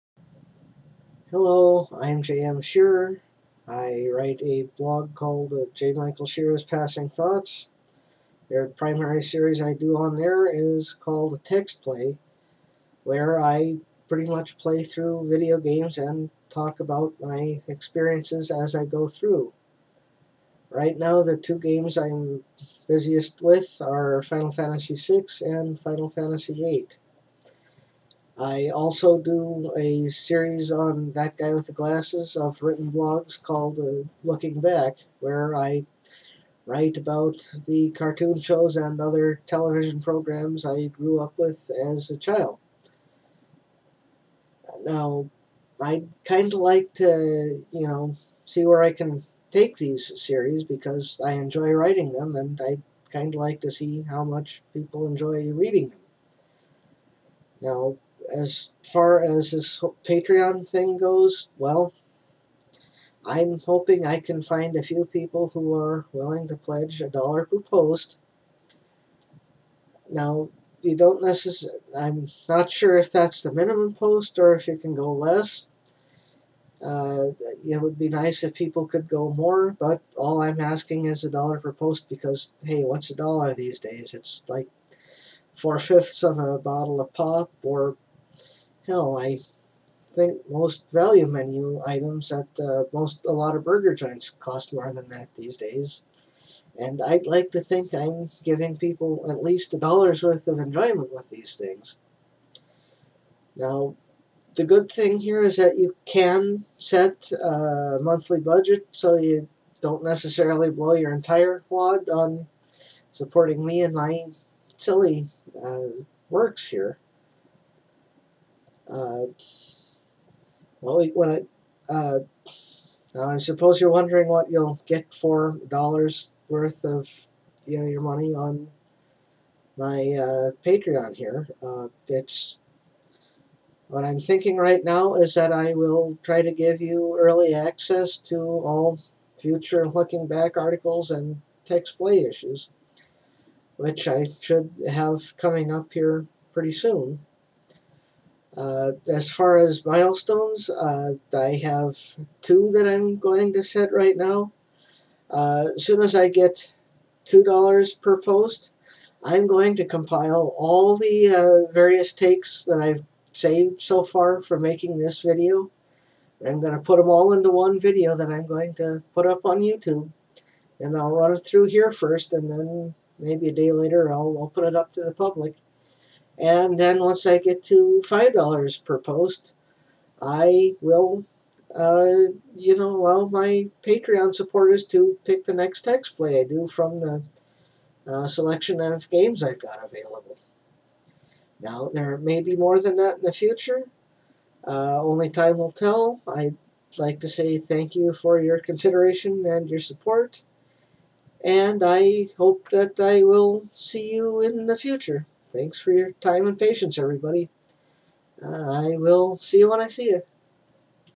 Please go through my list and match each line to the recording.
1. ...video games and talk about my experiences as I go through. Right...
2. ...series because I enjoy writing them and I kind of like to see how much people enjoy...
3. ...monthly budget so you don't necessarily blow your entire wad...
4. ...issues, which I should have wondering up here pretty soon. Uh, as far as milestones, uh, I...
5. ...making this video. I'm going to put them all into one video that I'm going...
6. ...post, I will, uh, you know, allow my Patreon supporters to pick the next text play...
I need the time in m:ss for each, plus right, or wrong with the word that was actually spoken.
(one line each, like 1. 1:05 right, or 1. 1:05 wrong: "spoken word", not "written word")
1. 0:15 right
2. 0:50 right
3. 1:48 right
4. 2:22 wrong: "coming", not "wondering"
5. 2:44 right
6. 2:58 right.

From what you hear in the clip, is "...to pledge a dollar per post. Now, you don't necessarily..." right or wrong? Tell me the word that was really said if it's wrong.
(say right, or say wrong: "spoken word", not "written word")
right.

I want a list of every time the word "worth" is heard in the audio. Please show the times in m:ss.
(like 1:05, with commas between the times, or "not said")
1:40, 2:06.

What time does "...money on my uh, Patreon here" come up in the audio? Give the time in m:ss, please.
2:08.